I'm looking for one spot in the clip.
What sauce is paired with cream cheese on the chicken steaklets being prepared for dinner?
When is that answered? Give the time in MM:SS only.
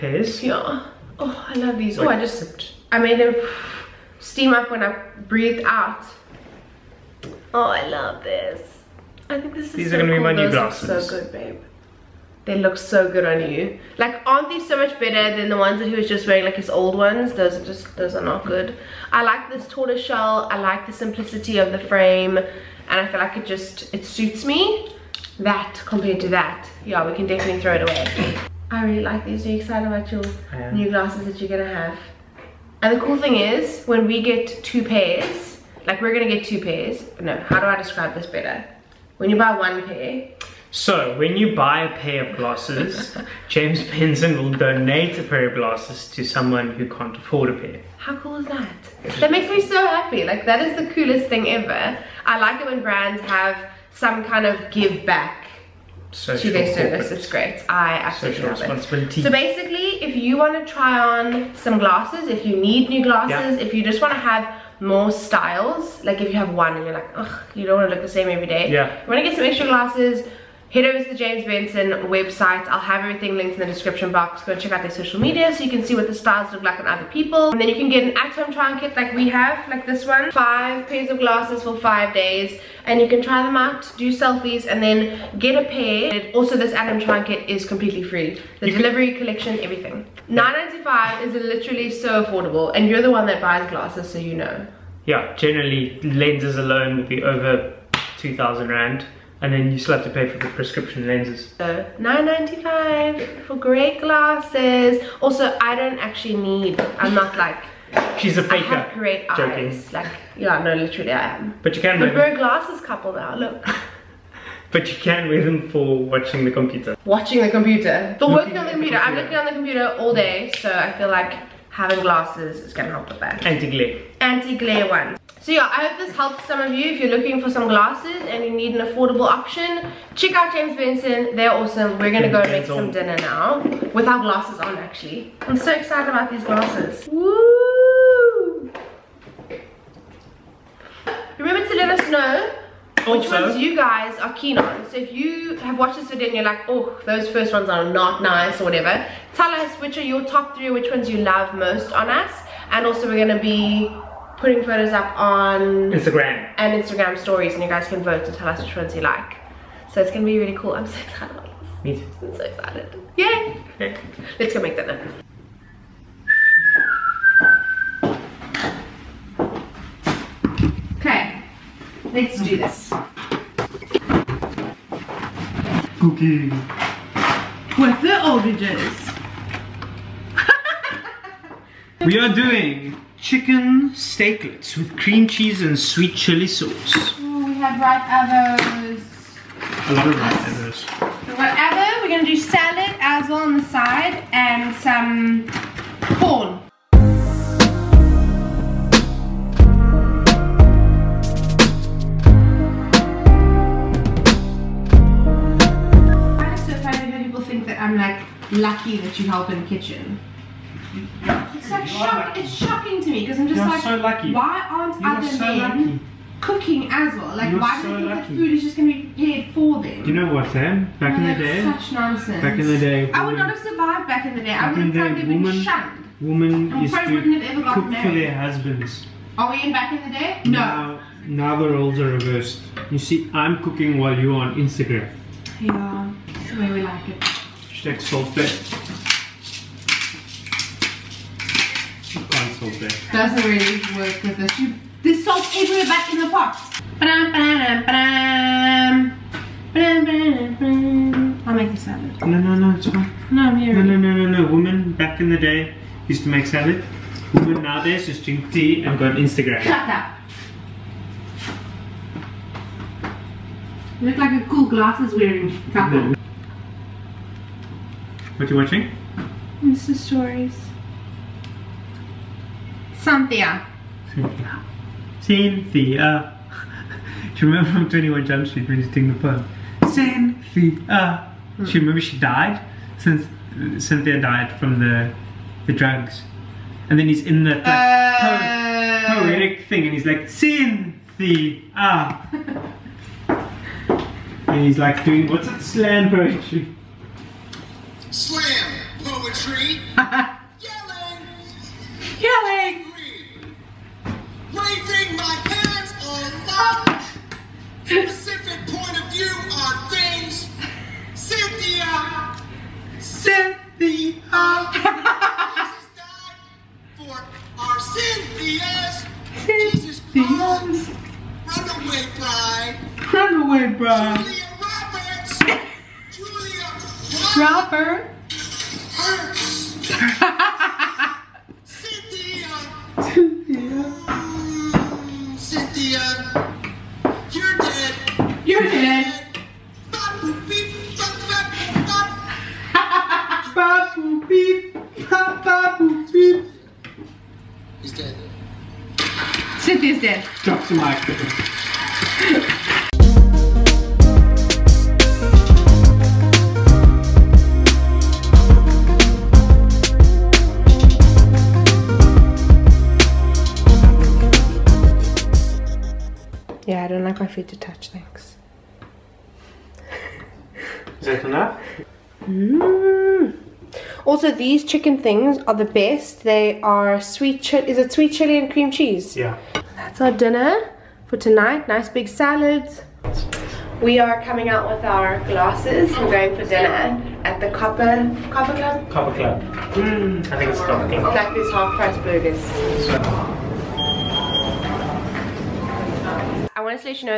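03:05.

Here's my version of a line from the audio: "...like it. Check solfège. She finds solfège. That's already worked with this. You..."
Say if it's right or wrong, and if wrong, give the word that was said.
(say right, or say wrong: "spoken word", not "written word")
right.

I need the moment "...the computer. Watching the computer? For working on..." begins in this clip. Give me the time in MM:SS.
01:56.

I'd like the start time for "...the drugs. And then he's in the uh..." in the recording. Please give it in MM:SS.
04:45.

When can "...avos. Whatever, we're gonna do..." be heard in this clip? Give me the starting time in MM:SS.
03:10.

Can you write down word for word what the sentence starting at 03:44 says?
I would have probably been woman, shunned.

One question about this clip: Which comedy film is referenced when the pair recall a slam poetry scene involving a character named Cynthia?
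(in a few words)
21 Jump Street.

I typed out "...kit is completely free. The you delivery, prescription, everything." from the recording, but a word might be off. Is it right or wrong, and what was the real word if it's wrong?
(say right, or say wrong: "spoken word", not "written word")
wrong: "collection", not "prescription".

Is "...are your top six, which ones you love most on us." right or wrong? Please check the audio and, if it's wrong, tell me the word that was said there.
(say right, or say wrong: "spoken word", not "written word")
wrong: "three", not "six".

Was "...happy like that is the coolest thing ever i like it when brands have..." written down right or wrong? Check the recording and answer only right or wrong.
right.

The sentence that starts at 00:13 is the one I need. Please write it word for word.
Like, aren't these so much better than the ones that he was just wearing, like his old ones?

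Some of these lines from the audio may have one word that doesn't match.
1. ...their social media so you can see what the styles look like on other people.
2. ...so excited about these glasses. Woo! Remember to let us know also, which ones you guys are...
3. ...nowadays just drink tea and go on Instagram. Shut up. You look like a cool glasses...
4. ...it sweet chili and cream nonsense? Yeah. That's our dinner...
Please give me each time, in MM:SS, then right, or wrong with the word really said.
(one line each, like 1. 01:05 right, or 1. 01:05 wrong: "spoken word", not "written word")
1. 01:14 right
2. 02:15 right
3. 04:17 right
4. 06:17 wrong: "cheese", not "nonsense".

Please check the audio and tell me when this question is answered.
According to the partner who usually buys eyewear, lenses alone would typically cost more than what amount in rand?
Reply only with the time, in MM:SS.
01:38.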